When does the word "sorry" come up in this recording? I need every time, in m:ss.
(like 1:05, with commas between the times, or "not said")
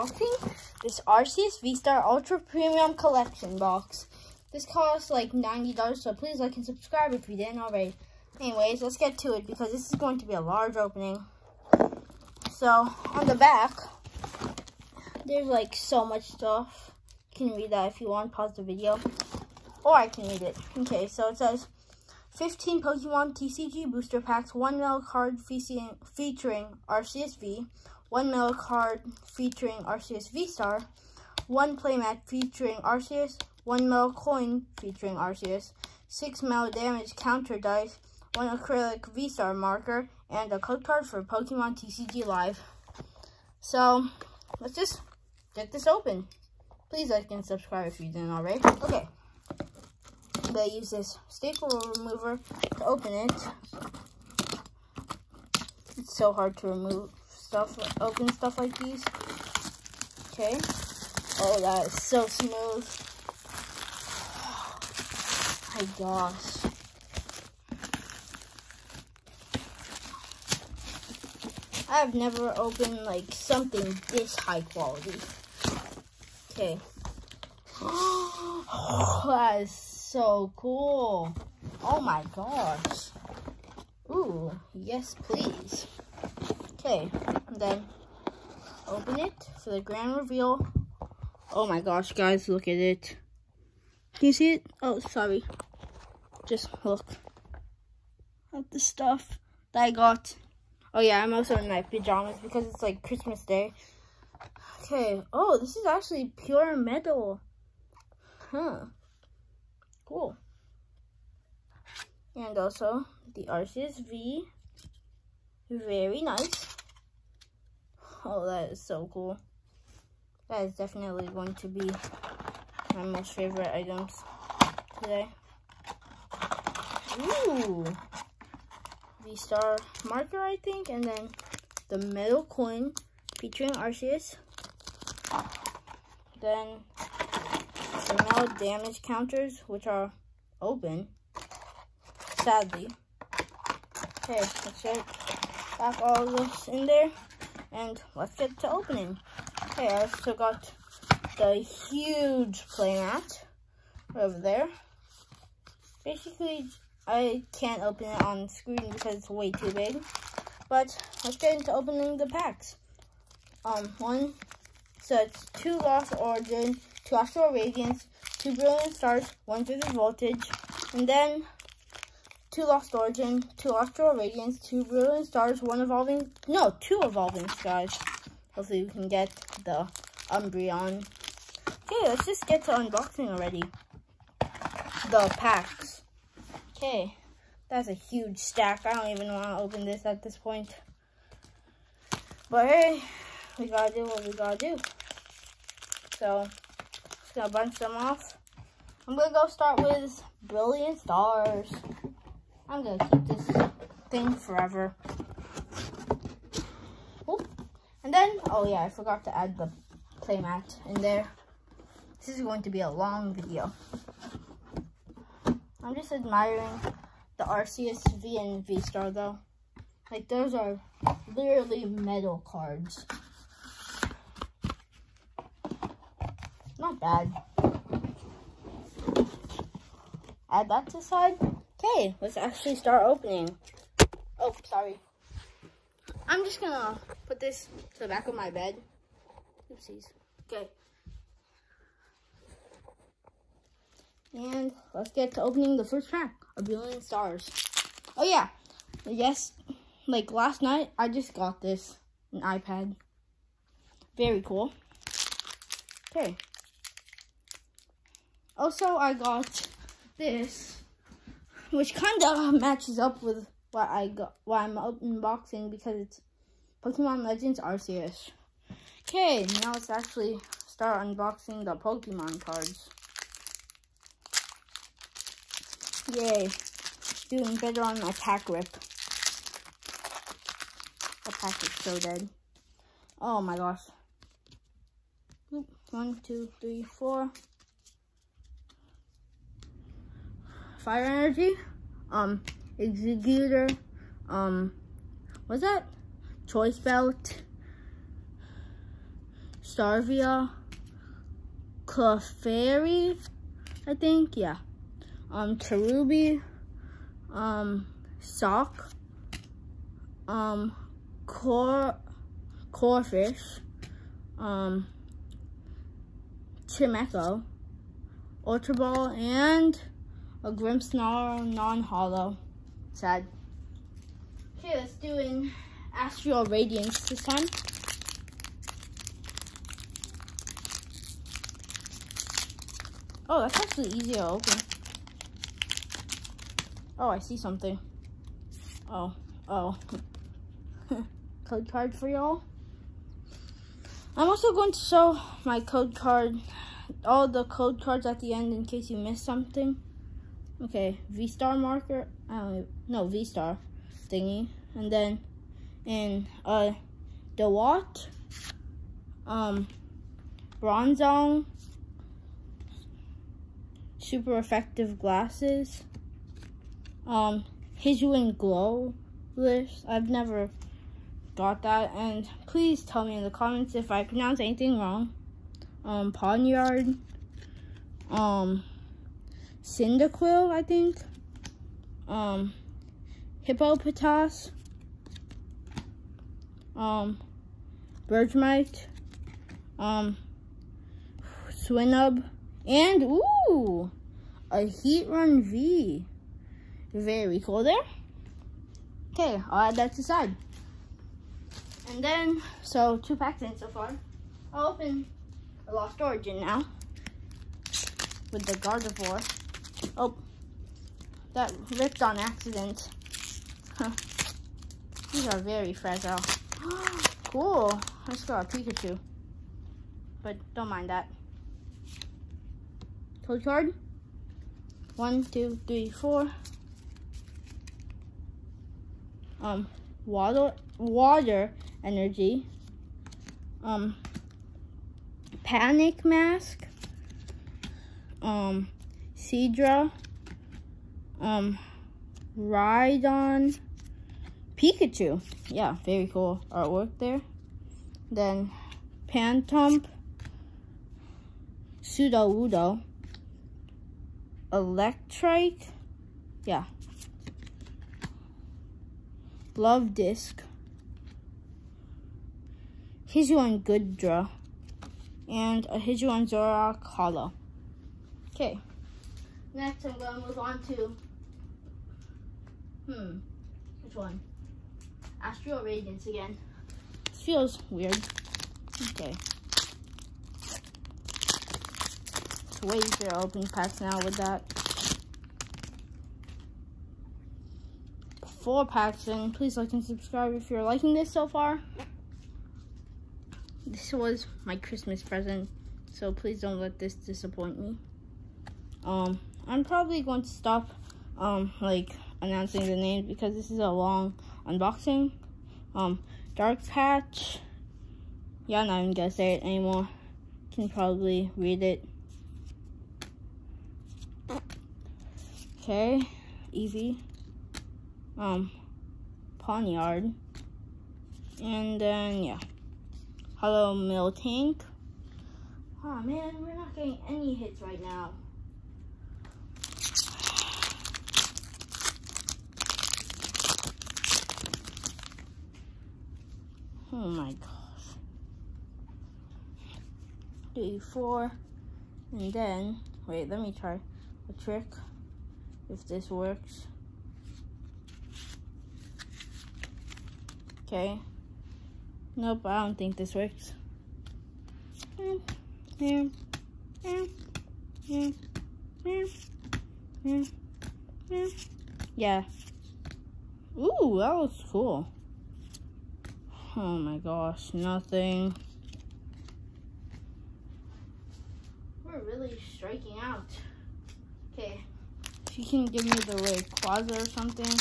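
1:34, 3:54.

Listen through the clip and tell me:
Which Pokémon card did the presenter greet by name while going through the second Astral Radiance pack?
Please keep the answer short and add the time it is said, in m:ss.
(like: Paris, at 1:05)
Miltank, at 8:43.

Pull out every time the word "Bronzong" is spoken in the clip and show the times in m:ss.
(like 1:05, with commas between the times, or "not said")
6:00.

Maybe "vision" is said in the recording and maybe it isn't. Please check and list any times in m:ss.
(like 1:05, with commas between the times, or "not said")
not said.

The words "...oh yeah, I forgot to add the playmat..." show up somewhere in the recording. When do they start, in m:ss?
3:28.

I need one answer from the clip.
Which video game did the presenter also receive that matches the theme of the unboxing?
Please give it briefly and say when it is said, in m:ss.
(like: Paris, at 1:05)
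Pokemon Legends Arceus, at 4:26.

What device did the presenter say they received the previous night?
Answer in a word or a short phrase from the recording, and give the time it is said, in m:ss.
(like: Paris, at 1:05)
iPad, at 4:12.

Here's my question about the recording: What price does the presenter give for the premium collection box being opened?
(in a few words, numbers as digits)
$90.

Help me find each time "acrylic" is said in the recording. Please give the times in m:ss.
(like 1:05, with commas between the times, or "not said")
0:38.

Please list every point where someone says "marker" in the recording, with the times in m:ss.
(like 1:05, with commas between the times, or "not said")
0:39, 2:10, 5:51.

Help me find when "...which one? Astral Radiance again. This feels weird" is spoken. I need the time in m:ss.
7:53.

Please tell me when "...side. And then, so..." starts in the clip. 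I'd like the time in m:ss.
6:40.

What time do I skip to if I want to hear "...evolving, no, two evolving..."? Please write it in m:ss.
2:55.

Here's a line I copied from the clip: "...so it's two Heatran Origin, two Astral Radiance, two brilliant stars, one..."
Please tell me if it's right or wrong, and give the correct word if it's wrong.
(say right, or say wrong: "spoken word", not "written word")
wrong: "Lost", not "Heatran".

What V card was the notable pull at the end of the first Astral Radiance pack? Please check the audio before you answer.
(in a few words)
Heatran V.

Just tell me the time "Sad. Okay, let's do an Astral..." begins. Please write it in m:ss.
5:22.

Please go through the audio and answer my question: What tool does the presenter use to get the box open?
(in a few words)
staple remover.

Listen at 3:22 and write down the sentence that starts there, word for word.
I'm gonna keep this thing forever.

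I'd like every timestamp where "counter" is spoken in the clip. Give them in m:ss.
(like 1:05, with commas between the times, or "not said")
0:37, 2:19.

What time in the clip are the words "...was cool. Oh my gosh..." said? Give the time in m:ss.
9:24.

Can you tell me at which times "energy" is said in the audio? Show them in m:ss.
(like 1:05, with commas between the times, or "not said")
4:51, 7:11.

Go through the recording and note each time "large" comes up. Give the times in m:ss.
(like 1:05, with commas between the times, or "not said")
0:10.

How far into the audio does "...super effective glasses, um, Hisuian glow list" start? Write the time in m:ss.
6:03.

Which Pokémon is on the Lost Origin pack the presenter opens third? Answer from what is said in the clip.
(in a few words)
Gardevoir.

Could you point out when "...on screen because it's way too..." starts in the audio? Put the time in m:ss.
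2:38.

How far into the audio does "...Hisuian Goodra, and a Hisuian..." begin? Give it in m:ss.
7:43.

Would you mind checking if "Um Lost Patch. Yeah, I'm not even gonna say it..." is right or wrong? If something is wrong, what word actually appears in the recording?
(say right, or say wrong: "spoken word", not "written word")
wrong: "Dark", not "Lost".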